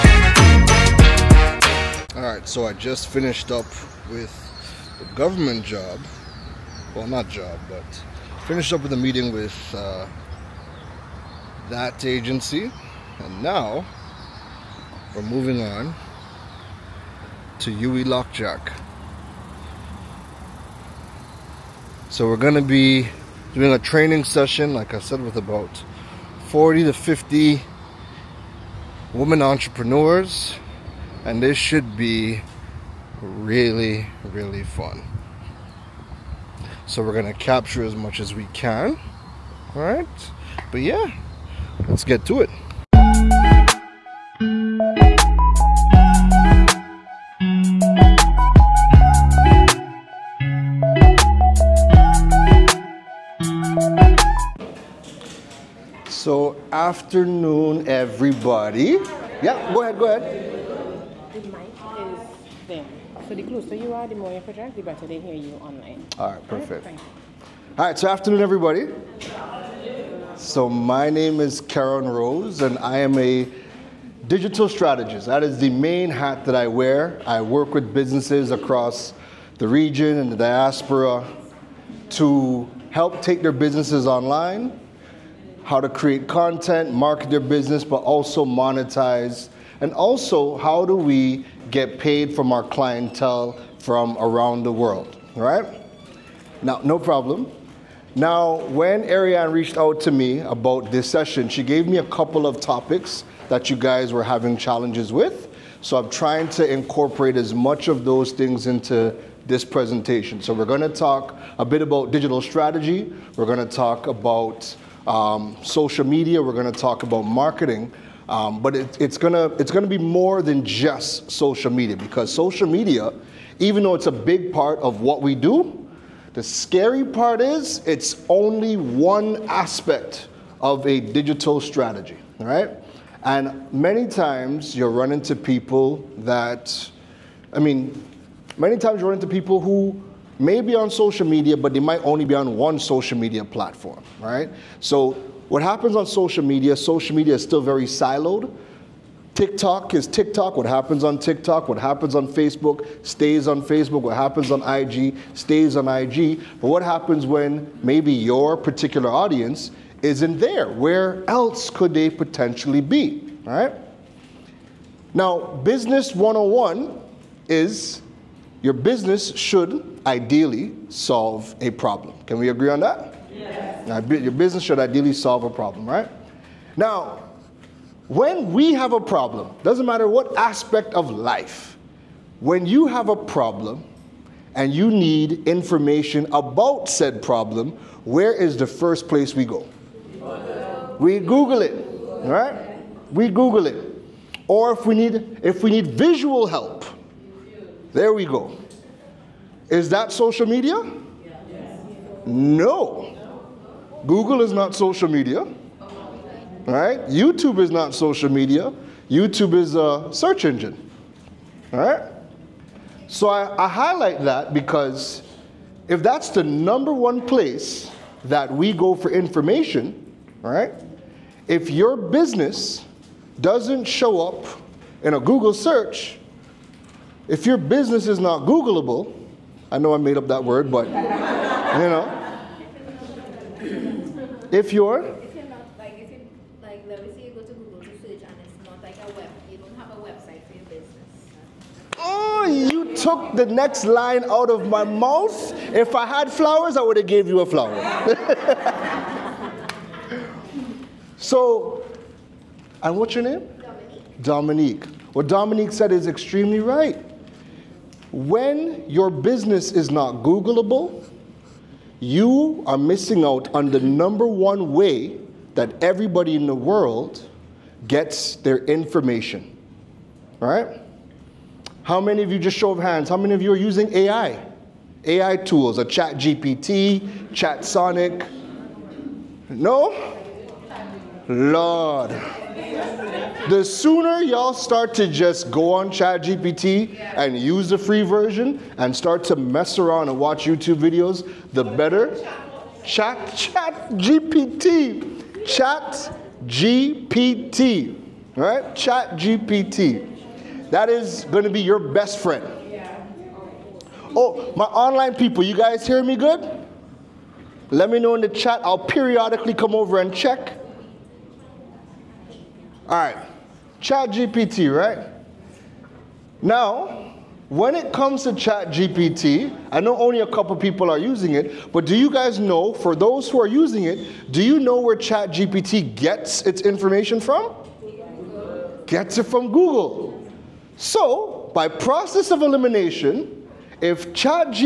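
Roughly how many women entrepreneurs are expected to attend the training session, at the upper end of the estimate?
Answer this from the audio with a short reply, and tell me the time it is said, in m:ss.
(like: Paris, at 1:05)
50, at 0:26.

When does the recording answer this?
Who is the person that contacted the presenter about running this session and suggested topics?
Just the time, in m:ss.
1:39.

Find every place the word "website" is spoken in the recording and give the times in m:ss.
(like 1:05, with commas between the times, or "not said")
4:00.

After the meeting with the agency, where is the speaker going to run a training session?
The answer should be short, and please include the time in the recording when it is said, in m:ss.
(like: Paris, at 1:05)
UWI Lok Jack, at 0:17.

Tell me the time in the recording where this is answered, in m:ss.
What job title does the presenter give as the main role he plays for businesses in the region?
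1:14.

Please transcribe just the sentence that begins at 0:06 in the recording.
Well, not job, but finished up with a meeting with uh, that agency.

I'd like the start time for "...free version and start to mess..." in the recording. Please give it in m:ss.
4:47.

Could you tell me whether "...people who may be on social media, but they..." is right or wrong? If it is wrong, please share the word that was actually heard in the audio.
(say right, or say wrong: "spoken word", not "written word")
right.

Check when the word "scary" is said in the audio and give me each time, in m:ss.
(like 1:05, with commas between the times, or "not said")
2:06.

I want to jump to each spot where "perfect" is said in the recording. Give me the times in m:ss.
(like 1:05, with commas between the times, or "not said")
1:06.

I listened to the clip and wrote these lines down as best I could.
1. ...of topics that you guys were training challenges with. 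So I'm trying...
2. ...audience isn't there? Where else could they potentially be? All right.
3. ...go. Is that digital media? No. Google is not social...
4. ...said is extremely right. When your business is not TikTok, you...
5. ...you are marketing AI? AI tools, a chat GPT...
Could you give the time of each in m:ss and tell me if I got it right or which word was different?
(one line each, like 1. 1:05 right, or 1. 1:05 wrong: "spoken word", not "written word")
1. 1:42 wrong: "having", not "training"
2. 2:39 right
3. 3:18 wrong: "social", not "digital"
4. 4:15 wrong: "Googleable", not "TikTok"
5. 4:33 wrong: "using", not "marketing".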